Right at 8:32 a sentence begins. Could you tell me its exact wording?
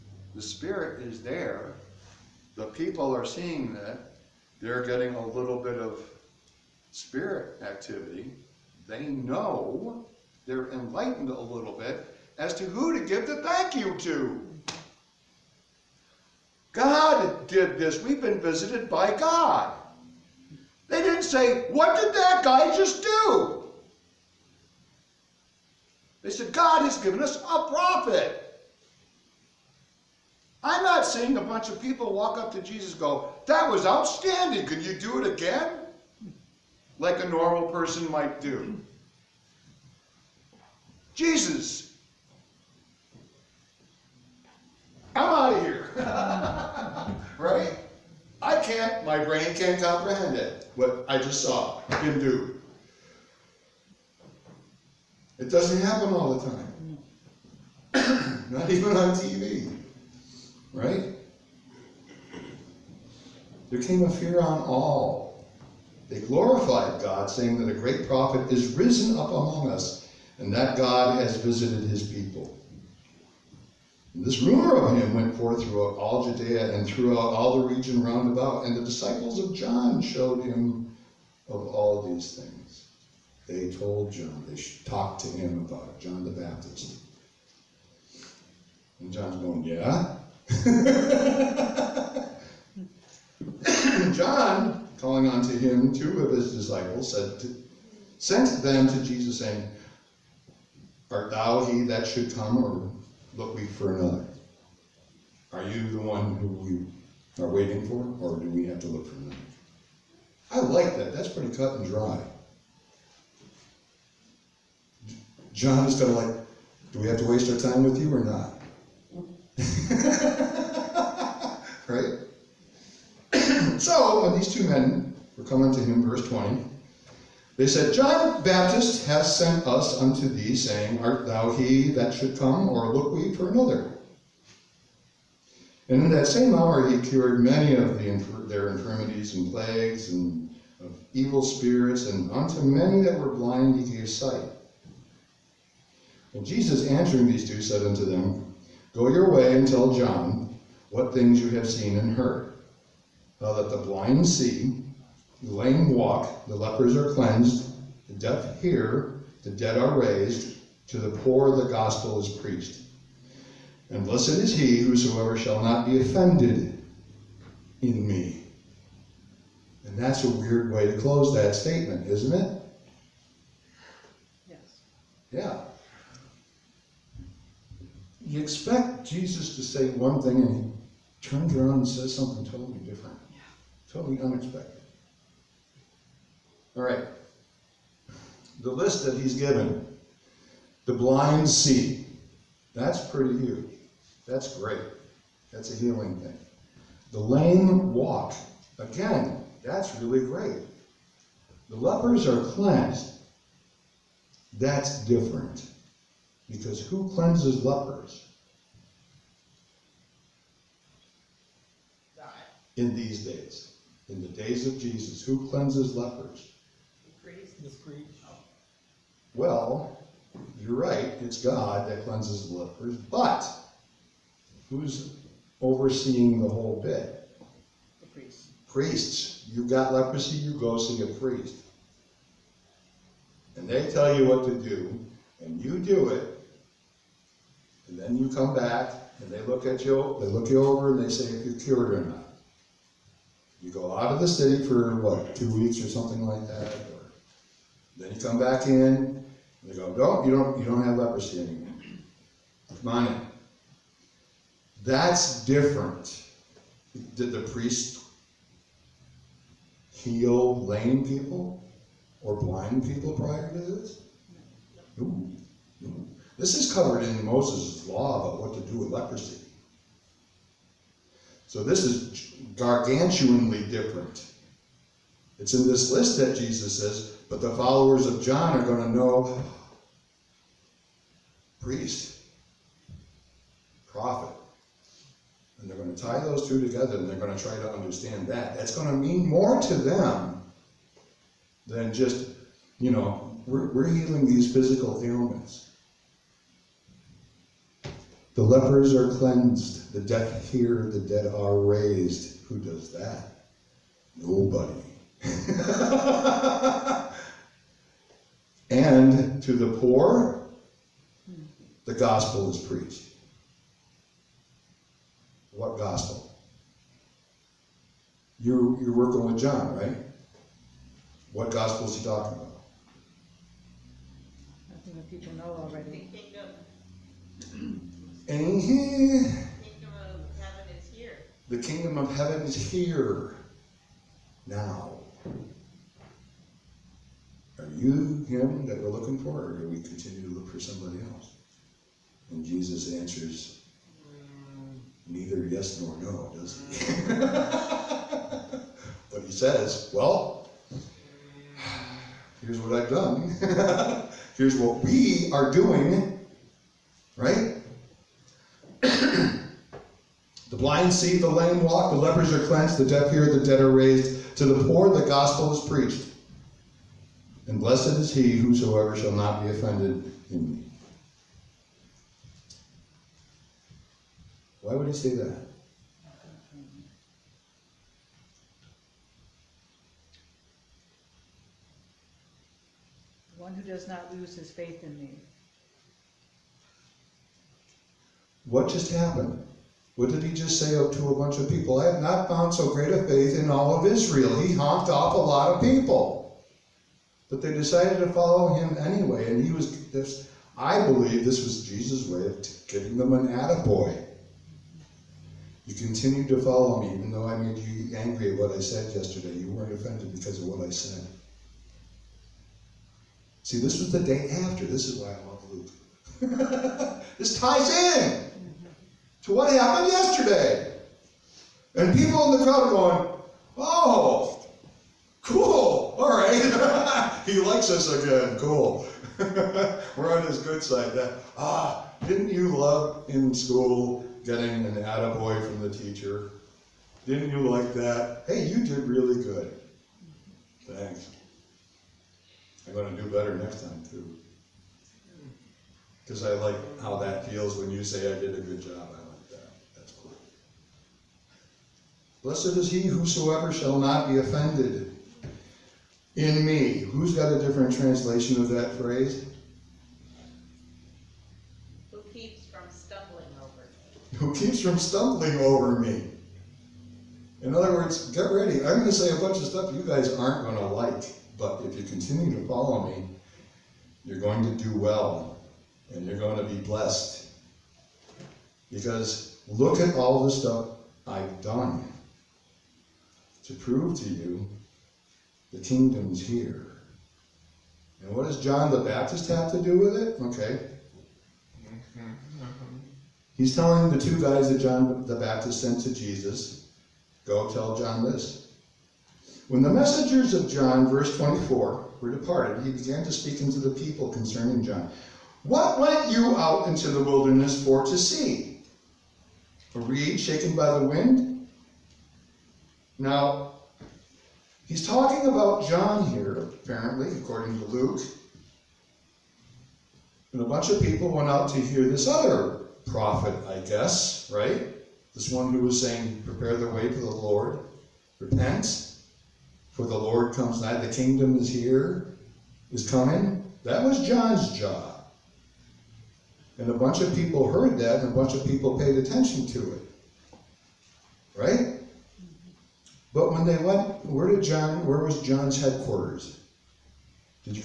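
Now, He's talking about John here, apparently, according to Luke.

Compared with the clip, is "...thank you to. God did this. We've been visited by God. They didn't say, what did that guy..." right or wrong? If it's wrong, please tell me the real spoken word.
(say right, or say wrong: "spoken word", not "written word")
right.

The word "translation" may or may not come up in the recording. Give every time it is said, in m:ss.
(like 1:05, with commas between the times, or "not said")
7:37.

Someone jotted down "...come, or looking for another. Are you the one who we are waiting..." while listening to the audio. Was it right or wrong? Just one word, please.
right.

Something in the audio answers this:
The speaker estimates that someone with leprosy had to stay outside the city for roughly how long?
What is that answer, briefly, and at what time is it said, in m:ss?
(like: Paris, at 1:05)
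Two weeks, at 4:05.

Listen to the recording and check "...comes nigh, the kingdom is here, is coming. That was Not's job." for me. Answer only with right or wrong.
wrong.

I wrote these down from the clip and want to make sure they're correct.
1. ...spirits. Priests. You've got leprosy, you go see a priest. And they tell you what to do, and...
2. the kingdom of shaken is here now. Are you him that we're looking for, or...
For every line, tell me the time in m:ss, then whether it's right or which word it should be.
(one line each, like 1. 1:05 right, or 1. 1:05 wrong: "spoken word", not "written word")
1. 3:48 wrong: "priests", not "spirits"
2. 5:31 wrong: "heaven", not "shaken".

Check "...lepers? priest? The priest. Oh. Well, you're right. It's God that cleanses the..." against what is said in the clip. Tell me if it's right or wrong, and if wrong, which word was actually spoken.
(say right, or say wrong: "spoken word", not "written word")
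right.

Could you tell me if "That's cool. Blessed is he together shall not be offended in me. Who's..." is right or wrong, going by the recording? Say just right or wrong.
wrong.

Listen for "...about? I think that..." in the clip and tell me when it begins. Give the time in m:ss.
5:22.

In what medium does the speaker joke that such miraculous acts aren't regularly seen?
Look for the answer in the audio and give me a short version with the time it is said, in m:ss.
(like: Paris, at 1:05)
TV, at 0:58.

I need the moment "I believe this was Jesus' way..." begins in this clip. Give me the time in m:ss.
6:40.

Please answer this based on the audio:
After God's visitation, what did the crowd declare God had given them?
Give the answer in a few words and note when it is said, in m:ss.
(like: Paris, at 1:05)
A prophet, at 0:26.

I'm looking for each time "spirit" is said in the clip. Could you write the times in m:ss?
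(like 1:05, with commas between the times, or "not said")
0:00, 0:06, 2:21.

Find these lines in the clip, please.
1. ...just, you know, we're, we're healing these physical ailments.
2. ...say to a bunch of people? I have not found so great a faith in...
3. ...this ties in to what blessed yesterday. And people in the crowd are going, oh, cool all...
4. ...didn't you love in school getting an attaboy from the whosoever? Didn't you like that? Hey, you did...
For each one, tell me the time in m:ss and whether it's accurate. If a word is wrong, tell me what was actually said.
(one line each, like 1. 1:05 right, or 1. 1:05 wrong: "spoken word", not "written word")
1. 4:51 right
2. 6:30 right
3. 6:57 wrong: "happened", not "blessed"
4. 7:12 wrong: "teacher", not "whosoever".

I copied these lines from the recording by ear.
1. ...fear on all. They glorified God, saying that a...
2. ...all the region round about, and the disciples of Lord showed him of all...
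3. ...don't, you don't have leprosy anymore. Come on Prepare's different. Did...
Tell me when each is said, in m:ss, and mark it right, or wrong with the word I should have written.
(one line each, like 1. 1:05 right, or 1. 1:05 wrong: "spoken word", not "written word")
1. 1:04 right
2. 1:17 wrong: "John", not "Lord"
3. 4:10 wrong: "That", not "Prepare".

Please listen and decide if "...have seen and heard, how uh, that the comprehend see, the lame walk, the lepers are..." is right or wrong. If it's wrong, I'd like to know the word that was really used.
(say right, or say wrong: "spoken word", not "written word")
wrong: "blind", not "comprehend".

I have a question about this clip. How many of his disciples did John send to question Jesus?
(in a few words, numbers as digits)
2.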